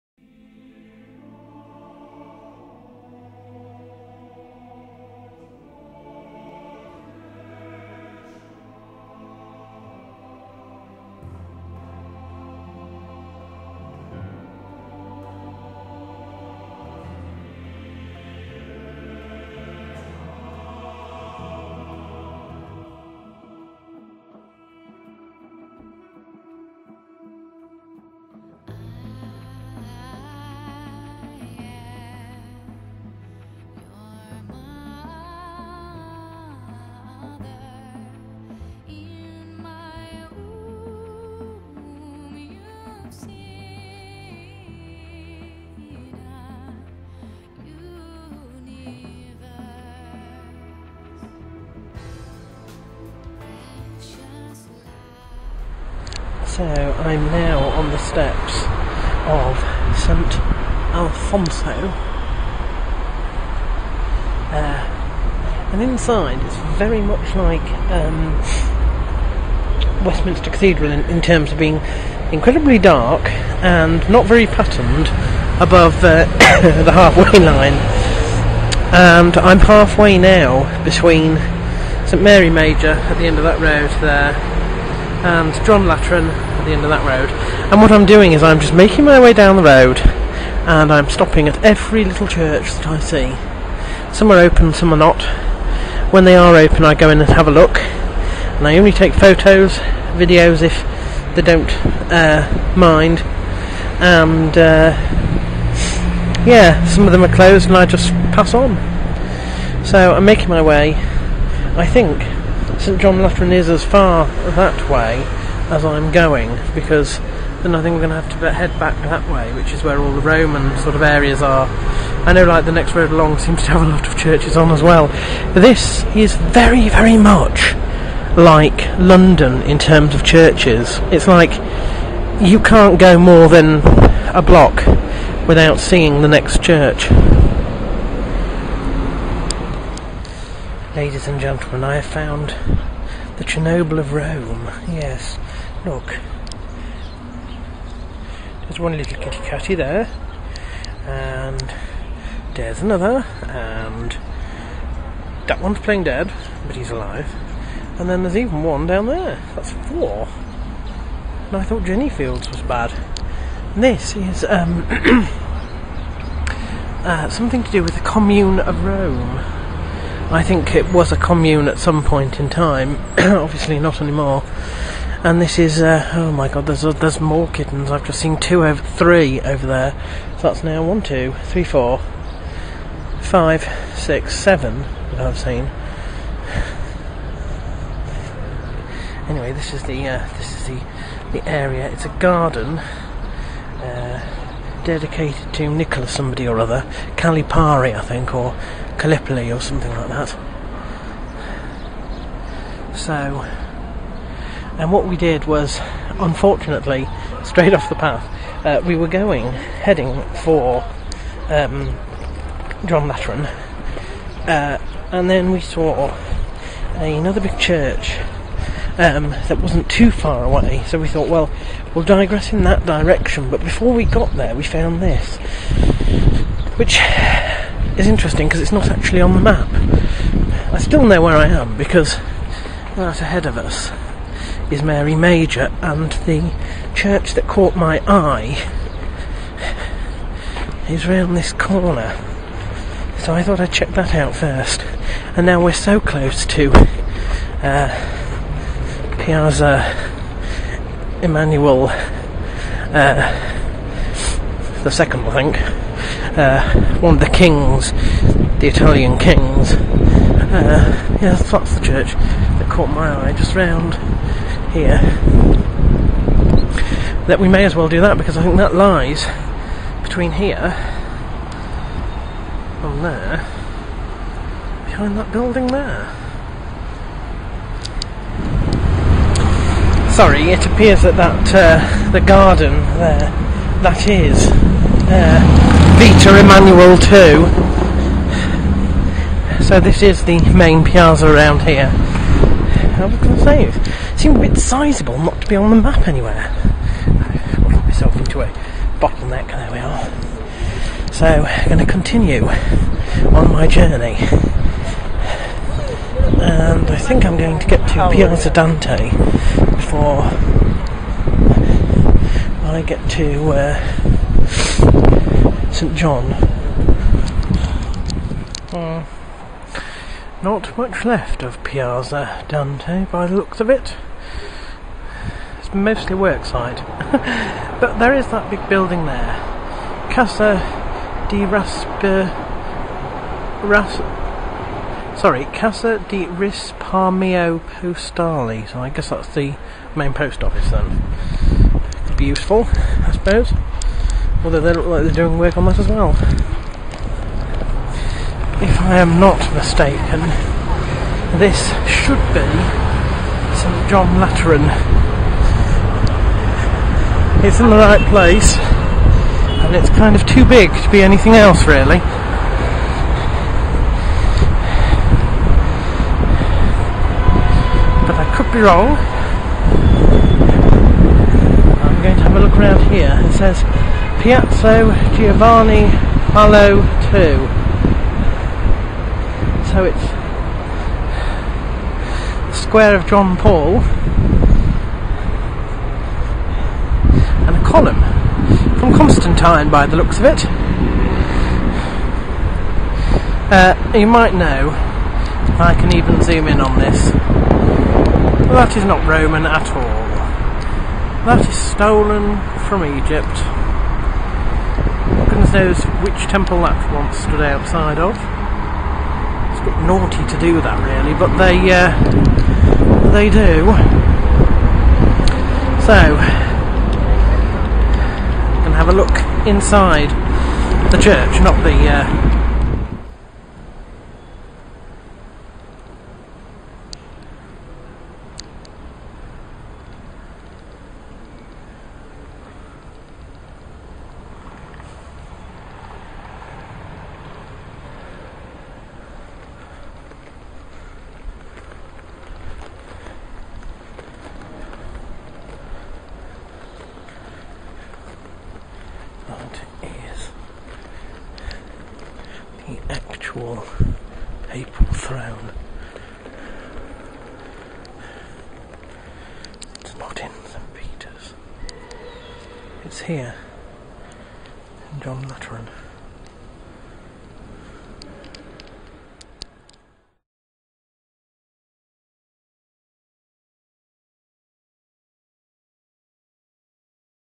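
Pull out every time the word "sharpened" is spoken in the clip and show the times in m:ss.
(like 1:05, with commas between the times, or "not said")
not said.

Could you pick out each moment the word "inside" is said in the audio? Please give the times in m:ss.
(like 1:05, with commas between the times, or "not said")
1:05, 6:59.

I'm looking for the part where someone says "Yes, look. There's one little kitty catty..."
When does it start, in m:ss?
2:24.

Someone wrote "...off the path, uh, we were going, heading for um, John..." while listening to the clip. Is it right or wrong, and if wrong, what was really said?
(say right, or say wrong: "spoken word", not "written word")
right.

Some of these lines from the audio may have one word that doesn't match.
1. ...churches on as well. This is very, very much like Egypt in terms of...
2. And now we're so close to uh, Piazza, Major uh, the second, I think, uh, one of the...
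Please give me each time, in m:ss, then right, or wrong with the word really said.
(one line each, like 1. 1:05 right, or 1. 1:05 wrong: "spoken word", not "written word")
1. 2:04 wrong: "London", not "Egypt"
2. 4:05 wrong: "Emmanuel", not "Major".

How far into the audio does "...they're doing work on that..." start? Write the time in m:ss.
5:45.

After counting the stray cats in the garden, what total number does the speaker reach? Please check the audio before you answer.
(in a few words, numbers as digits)
7.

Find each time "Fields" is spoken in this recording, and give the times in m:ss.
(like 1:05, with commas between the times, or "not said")
2:42.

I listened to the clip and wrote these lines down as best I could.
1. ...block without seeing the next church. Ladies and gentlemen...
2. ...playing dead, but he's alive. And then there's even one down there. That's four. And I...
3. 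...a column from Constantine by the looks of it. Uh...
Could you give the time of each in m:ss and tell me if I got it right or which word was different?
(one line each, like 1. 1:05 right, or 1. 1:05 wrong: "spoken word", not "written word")
1. 2:14 right
2. 2:35 right
3. 6:27 right.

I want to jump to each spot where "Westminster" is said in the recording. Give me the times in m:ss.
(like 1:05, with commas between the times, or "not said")
1:10.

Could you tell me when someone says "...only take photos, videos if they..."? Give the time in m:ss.
1:38.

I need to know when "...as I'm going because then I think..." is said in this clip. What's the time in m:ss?
1:55.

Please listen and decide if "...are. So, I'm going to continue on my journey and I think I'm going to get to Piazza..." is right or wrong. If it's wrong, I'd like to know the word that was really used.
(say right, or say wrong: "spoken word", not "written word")
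right.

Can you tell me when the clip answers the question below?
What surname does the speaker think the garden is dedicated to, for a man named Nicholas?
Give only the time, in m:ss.
3:17.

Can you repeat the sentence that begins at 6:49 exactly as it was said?
It's a bit naughty to do that, really, but they uh, they do.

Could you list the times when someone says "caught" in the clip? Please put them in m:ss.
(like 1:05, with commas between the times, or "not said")
3:57, 4:22.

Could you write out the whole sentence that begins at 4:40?
sorry, it appears that that uh, the garden there, that is uh, Vita Emmanuel 2.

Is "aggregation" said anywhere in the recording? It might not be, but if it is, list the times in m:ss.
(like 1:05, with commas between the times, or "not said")
not said.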